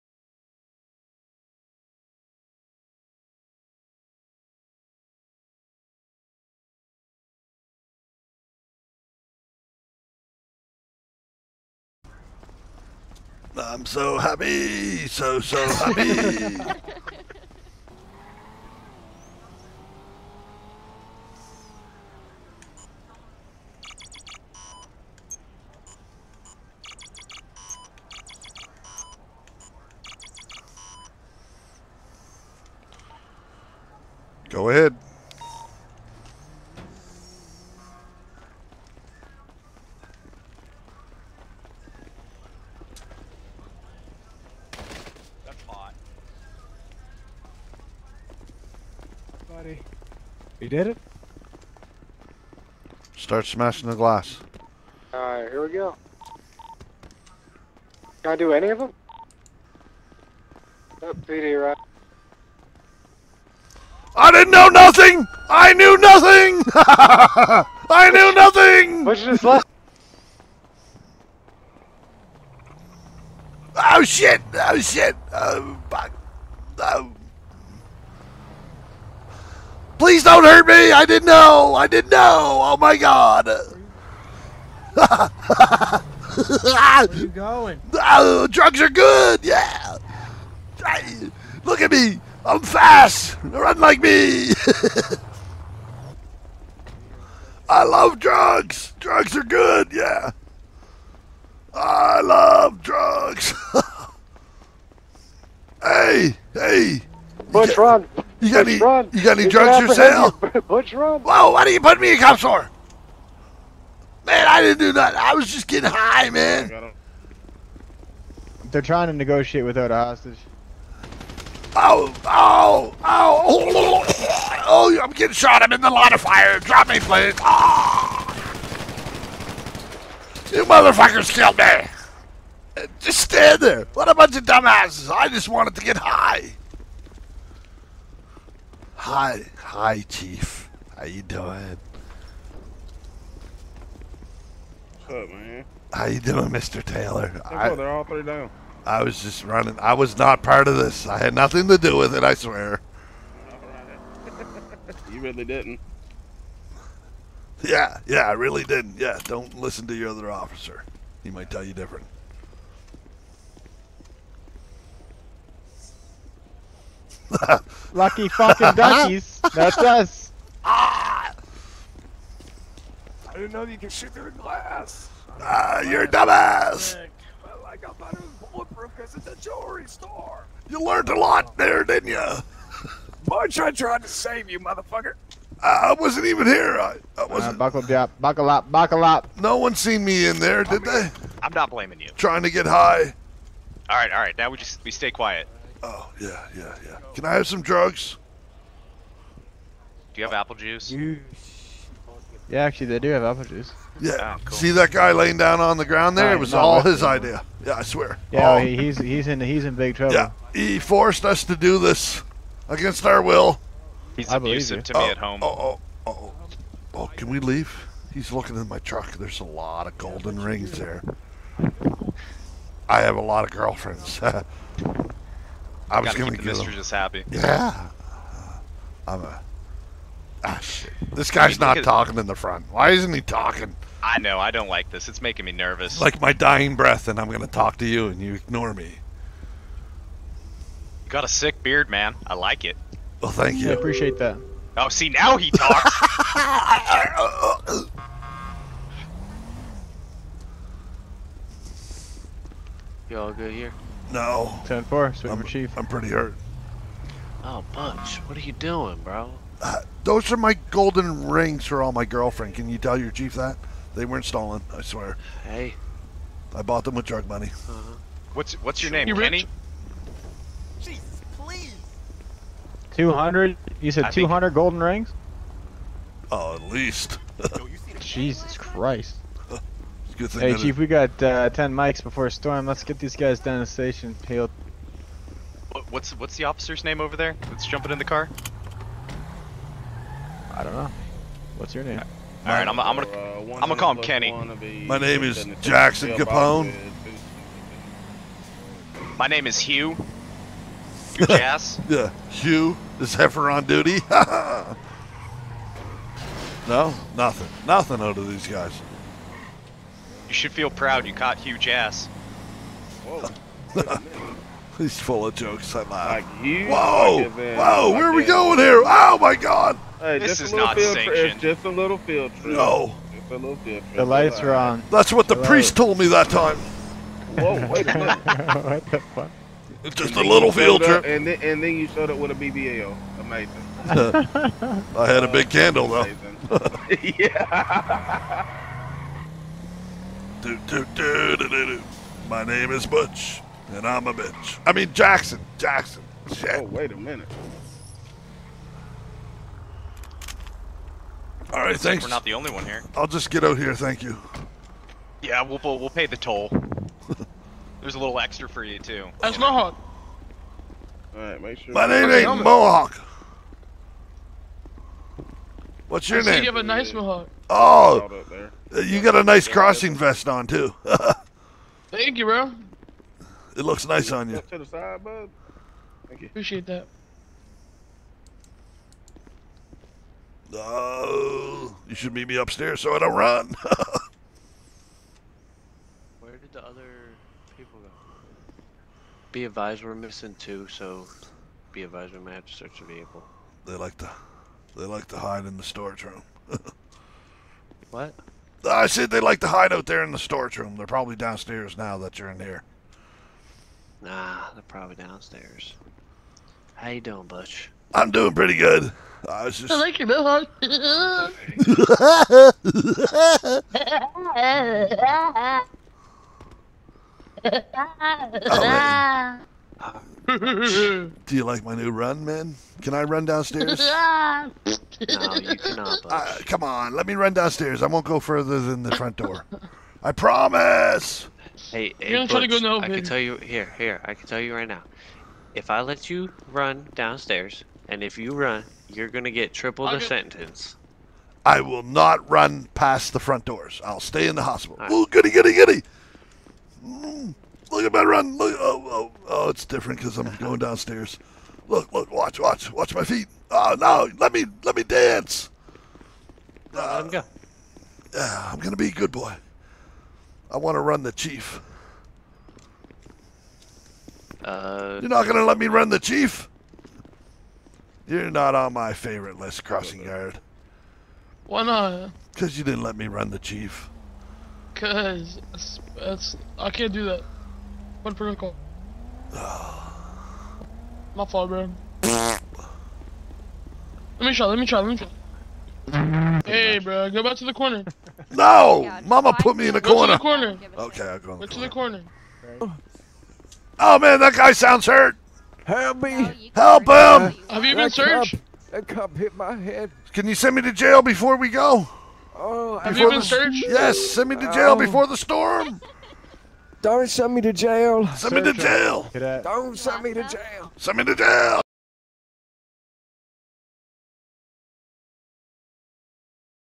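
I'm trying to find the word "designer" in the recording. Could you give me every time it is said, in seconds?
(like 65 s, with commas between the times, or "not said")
not said.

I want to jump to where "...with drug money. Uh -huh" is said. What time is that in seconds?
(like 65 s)
266 s.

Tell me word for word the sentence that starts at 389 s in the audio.
Be advised, we're missing two, so be advised we might have to search the vehicle.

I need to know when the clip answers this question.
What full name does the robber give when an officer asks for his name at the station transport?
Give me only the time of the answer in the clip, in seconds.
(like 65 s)
295 s.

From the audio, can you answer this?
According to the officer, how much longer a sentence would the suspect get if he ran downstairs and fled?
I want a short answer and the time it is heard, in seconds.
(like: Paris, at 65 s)
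Triple, at 439 s.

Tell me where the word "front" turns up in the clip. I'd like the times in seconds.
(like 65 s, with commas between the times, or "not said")
232 s, 428 s, 443 s.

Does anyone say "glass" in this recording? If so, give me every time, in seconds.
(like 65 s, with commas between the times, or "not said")
53 s, 174 s.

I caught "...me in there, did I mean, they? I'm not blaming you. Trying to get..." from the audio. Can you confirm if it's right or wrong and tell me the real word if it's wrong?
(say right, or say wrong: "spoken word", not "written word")
right.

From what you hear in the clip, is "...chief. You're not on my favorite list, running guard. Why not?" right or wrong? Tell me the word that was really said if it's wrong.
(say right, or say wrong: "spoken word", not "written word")
wrong: "crossing", not "running".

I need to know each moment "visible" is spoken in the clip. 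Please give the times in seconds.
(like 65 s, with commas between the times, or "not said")
not said.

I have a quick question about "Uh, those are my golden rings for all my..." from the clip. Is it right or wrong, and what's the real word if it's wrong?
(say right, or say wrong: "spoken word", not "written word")
right.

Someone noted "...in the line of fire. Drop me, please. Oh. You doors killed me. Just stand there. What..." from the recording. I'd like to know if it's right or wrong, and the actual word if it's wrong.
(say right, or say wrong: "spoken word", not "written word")
wrong: "motherfuckers", not "doors".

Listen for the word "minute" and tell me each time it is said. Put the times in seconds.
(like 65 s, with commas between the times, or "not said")
327 s, 346 s.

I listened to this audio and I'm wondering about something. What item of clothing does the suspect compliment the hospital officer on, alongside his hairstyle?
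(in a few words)
Crossing vest.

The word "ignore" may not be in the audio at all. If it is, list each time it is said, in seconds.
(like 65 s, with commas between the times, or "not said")
238 s.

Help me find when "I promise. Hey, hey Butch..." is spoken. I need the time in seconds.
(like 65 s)
430 s.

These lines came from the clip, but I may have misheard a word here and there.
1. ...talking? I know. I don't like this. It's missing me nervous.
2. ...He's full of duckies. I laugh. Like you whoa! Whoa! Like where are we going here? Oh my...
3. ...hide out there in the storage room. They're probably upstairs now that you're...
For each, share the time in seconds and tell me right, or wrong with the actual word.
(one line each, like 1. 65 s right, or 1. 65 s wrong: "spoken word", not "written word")
1. 233 s wrong: "making", not "missing"
2. 314 s wrong: "jokes", not "duckies"
3. 399 s wrong: "downstairs", not "upstairs".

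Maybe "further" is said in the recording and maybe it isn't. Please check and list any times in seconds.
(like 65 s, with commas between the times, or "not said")
428 s.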